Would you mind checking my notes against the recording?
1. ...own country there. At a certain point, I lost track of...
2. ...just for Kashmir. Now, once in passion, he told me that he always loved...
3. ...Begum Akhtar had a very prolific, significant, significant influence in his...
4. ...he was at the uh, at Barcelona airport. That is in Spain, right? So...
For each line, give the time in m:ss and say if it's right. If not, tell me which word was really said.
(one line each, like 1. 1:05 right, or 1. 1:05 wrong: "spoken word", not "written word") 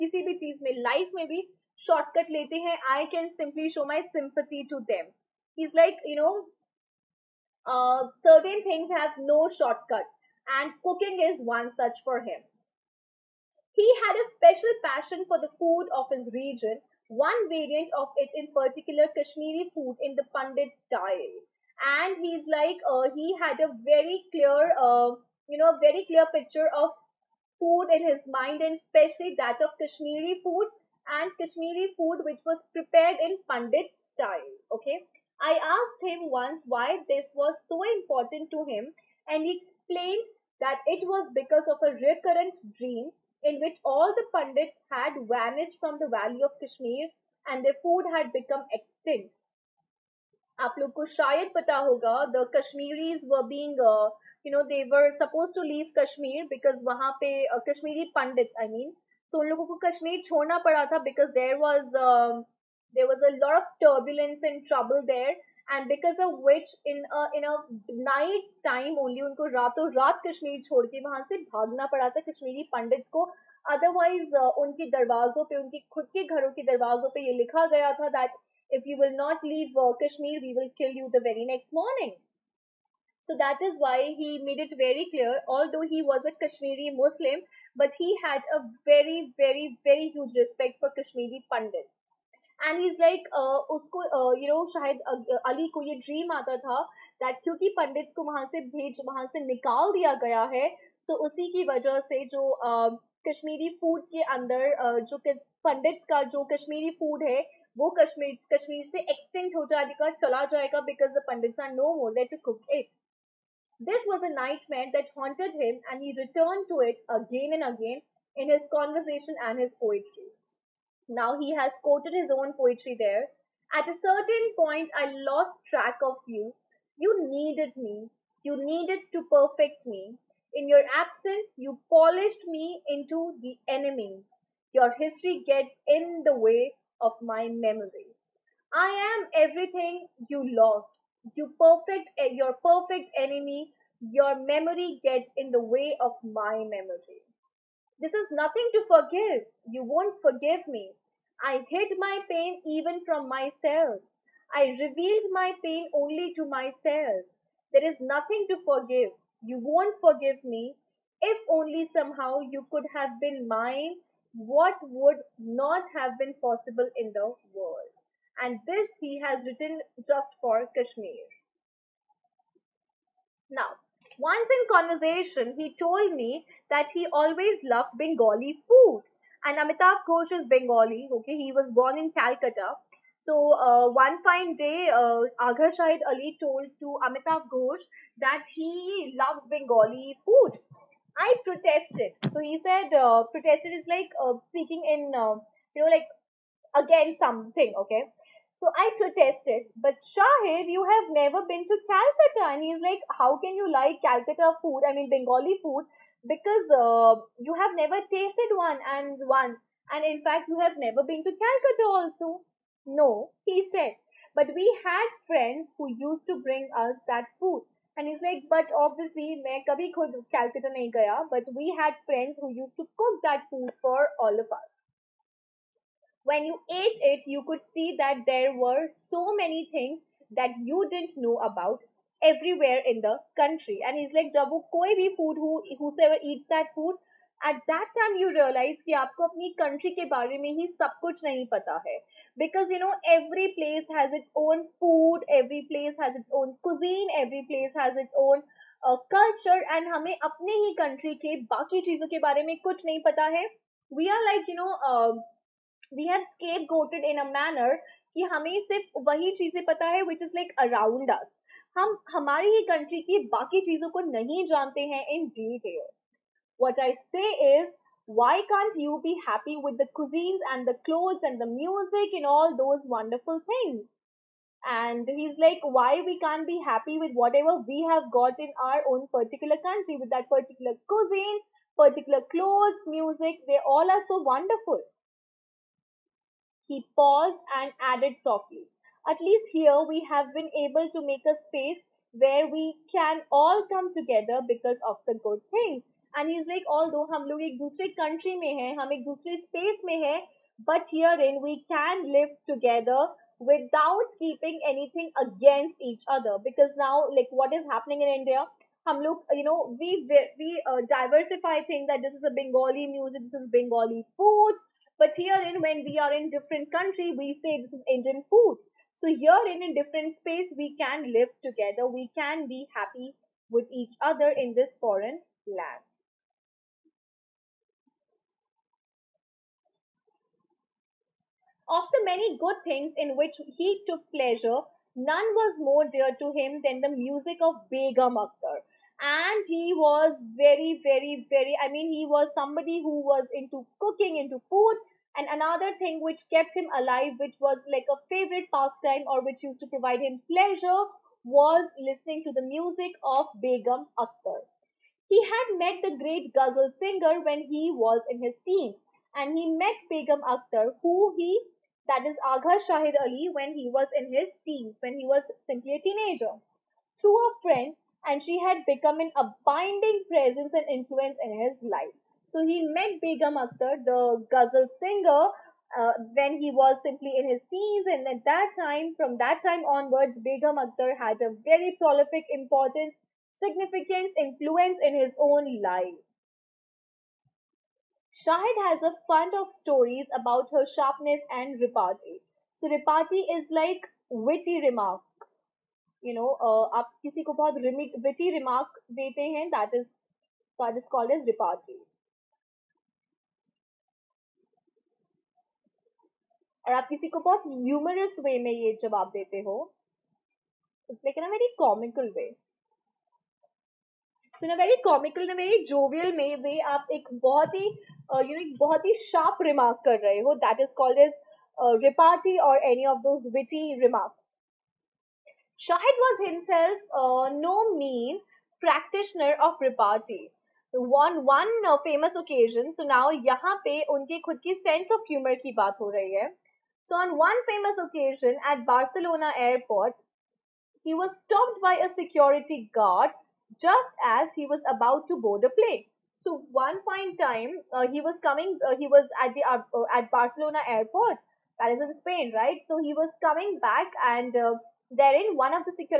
1. 2:02 wrong: "poetry", not "country"
2. 2:50 wrong: "conversation", not "passion"
3. 6:20 wrong: "important", not "significant"
4. 7:28 right.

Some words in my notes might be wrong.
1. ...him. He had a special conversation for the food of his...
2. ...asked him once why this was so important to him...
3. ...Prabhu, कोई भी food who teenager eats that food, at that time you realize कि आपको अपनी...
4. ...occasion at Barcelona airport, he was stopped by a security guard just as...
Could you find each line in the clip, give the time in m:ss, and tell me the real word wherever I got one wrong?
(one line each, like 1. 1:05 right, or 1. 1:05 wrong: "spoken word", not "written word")
1. 0:12 wrong: "passion", not "conversation"
2. 0:35 right
3. 3:54 wrong: "whosoever", not "teenager"
4. 7:17 right.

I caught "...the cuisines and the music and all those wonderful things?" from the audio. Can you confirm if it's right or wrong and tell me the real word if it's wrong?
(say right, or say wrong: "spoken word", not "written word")
wrong: "clothes", not "cuisines".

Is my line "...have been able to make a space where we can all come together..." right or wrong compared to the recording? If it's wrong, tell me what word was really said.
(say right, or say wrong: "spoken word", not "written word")
right.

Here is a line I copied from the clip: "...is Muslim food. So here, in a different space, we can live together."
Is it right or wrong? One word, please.
wrong.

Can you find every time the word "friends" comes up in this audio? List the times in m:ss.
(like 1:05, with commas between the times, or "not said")
3:35, 3:42, 6:07.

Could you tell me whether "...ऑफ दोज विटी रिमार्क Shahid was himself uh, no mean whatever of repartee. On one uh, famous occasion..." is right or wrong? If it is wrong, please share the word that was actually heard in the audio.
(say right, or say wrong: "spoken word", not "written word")
wrong: "practitioner", not "whatever".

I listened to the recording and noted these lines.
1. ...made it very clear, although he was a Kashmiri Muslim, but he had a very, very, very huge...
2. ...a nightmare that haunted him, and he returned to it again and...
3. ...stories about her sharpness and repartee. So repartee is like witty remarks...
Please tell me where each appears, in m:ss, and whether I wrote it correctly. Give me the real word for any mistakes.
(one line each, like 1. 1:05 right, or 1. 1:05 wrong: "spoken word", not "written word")
1. 1:24 right
2. 1:54 right
3. 6:29 right.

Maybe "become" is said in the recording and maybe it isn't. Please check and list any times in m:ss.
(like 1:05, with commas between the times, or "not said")
0:48, 6:08.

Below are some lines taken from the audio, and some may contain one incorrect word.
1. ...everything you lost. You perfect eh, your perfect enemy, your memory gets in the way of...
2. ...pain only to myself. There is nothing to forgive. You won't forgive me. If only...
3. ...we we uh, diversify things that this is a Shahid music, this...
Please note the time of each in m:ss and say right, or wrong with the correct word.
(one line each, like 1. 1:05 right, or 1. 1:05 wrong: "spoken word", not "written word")
1. 2:19 right
2. 2:35 right
3. 5:09 wrong: "Bengali", not "Shahid".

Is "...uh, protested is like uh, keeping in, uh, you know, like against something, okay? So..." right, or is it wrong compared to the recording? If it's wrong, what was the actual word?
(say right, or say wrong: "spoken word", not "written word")
wrong: "speaking", not "keeping".